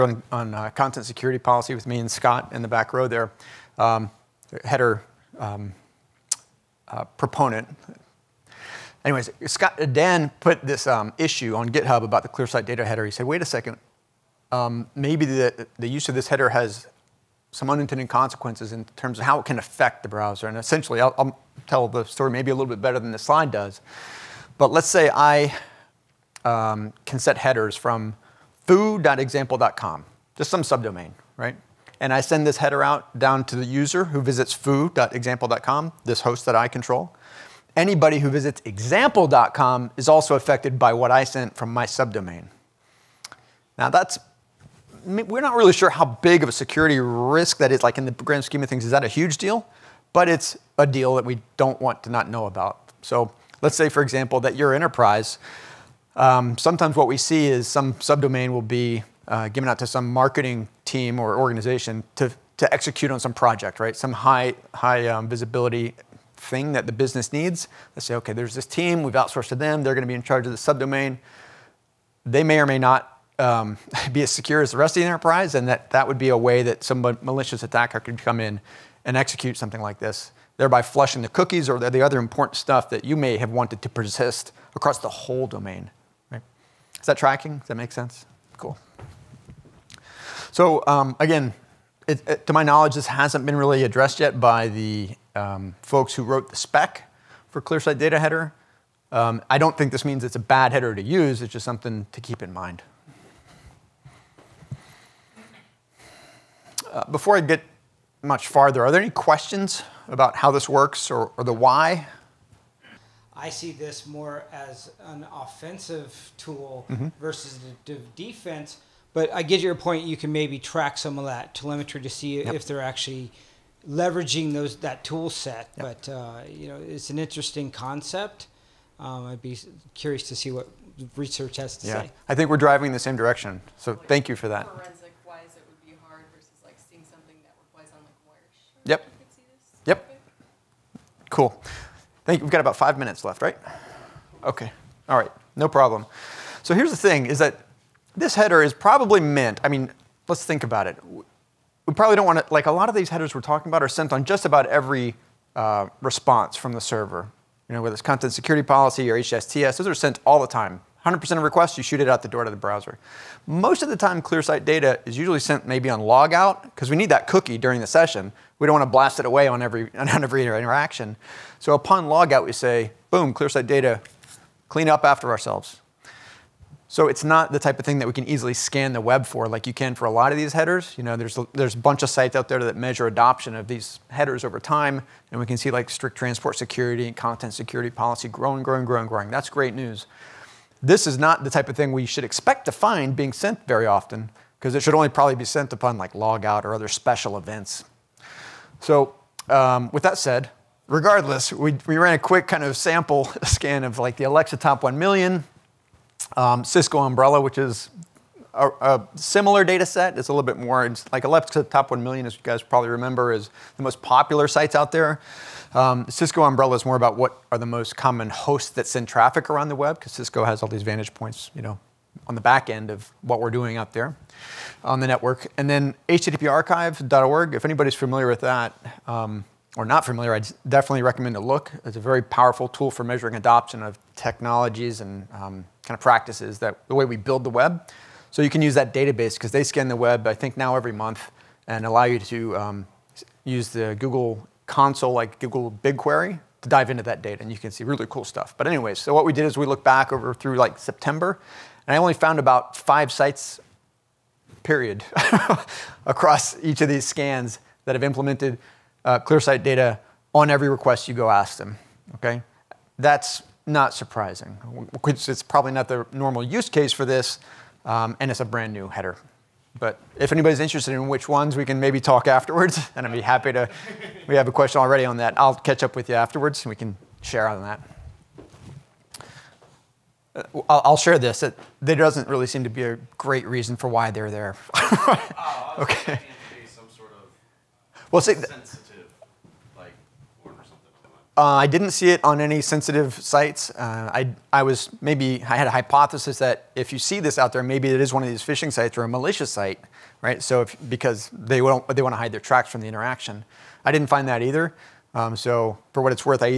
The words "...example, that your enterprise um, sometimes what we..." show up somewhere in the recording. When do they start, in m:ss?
0:54.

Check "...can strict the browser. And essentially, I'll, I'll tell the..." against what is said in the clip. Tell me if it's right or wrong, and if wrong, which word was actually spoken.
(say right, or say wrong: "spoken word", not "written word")
wrong: "affect", not "strict".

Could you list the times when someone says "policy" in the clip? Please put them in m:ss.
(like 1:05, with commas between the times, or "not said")
0:01, 2:38, 3:07.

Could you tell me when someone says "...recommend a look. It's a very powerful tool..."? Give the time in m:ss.
3:51.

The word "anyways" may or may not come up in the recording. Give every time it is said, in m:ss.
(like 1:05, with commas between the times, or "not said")
0:09, 4:08.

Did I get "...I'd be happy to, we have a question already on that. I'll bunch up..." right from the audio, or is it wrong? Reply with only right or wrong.
wrong.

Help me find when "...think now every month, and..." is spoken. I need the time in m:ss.
4:00.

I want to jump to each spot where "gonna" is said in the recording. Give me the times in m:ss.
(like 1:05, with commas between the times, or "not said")
1:09.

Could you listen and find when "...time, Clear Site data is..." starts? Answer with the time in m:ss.
2:43.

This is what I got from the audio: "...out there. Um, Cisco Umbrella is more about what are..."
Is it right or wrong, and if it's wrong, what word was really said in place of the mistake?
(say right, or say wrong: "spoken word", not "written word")
right.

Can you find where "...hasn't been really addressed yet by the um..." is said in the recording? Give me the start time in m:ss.
1:33.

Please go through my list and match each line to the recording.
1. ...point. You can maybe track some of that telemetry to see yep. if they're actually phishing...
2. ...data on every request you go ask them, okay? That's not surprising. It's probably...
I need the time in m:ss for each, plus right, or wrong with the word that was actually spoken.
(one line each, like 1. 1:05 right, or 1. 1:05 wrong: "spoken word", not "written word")
1. 1:59 wrong: "leveraging", not "phishing"
2. 4:19 right.